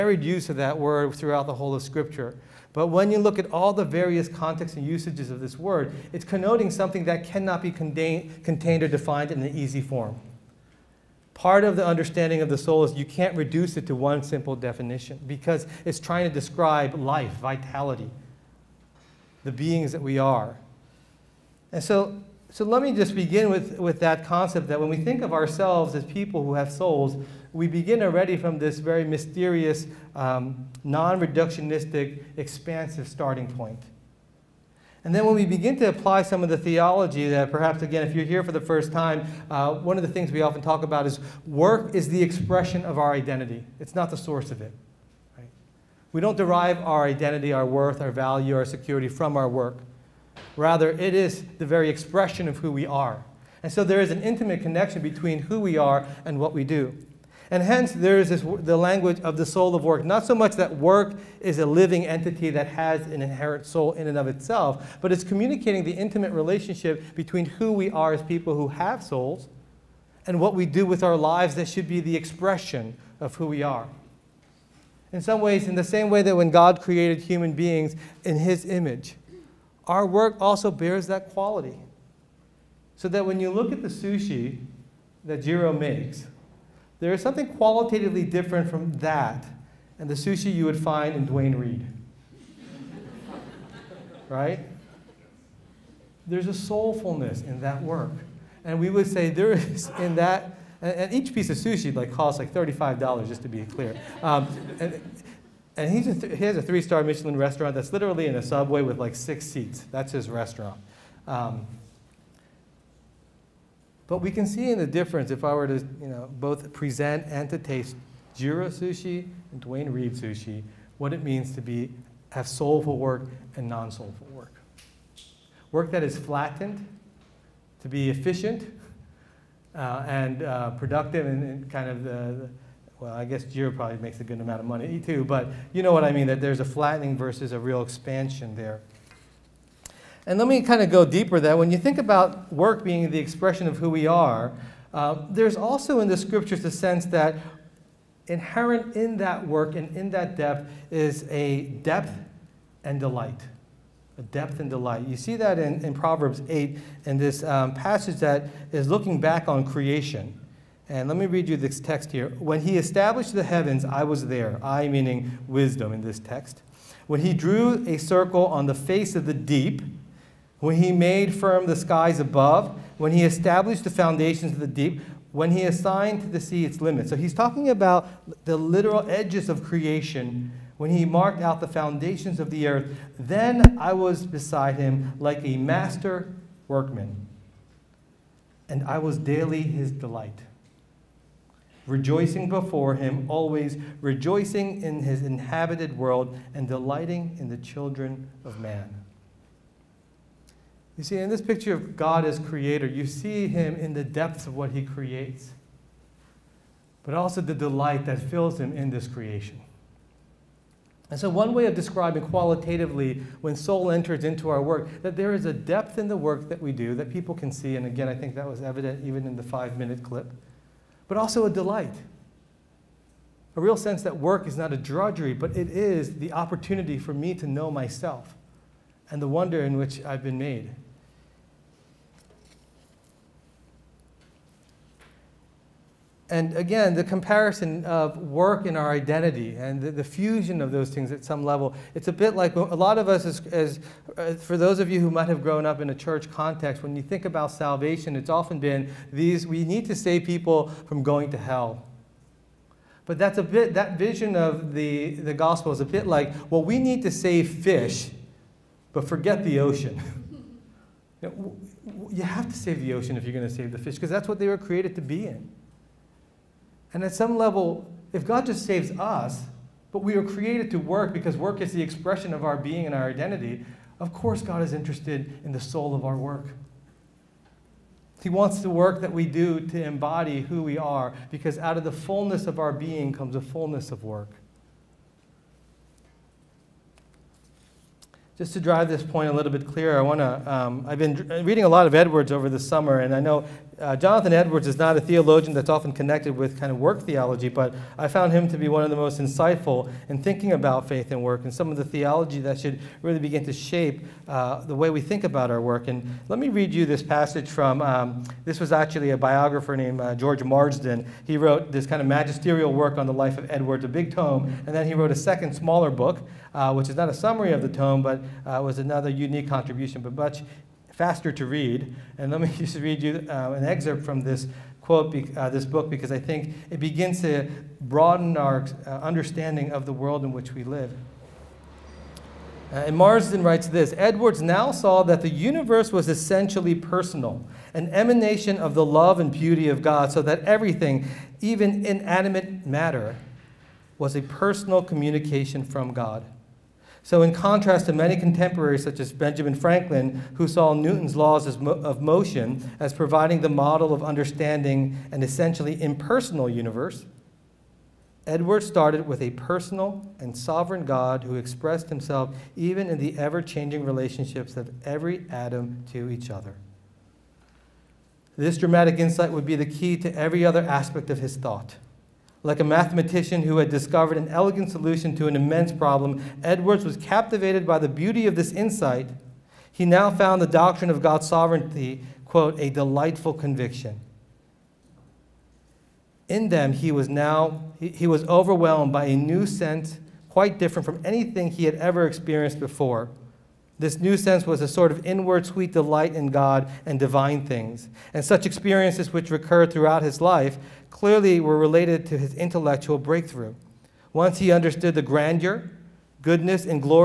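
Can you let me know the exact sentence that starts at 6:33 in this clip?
This new sense was a sort of inward sweet delight in God and divine things.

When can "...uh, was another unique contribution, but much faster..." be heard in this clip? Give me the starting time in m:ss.
5:18.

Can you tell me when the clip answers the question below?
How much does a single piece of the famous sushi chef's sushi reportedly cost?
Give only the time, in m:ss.
1:42.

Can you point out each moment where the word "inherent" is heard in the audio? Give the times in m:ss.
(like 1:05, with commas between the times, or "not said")
1:03, 2:28.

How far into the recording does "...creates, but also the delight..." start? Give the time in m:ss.
3:24.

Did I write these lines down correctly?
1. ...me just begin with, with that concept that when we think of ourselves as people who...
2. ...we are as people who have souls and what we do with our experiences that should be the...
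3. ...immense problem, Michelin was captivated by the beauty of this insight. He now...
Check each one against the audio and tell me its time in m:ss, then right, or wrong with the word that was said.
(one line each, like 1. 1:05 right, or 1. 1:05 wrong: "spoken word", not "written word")
1. 0:22 right
2. 1:07 wrong: "lives", not "experiences"
3. 6:15 wrong: "Edwards", not "Michelin".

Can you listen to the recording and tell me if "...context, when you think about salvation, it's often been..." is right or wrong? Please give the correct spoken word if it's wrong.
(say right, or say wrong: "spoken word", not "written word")
right.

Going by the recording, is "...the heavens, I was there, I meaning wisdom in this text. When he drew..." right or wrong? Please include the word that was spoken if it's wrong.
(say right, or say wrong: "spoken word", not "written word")
right.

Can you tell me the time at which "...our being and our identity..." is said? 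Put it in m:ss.
4:32.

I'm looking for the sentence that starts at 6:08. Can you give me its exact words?
This dramatic insight would be the key to every other aspect of his thought.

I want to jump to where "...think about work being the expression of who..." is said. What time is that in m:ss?
2:21.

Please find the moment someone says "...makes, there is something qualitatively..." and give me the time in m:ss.
1:25.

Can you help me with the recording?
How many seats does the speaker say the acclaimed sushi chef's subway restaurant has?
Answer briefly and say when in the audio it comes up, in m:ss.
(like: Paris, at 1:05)
6, at 1:49.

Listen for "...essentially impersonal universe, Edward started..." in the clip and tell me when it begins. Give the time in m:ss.
5:55.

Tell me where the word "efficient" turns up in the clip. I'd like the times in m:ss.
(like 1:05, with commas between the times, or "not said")
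2:08.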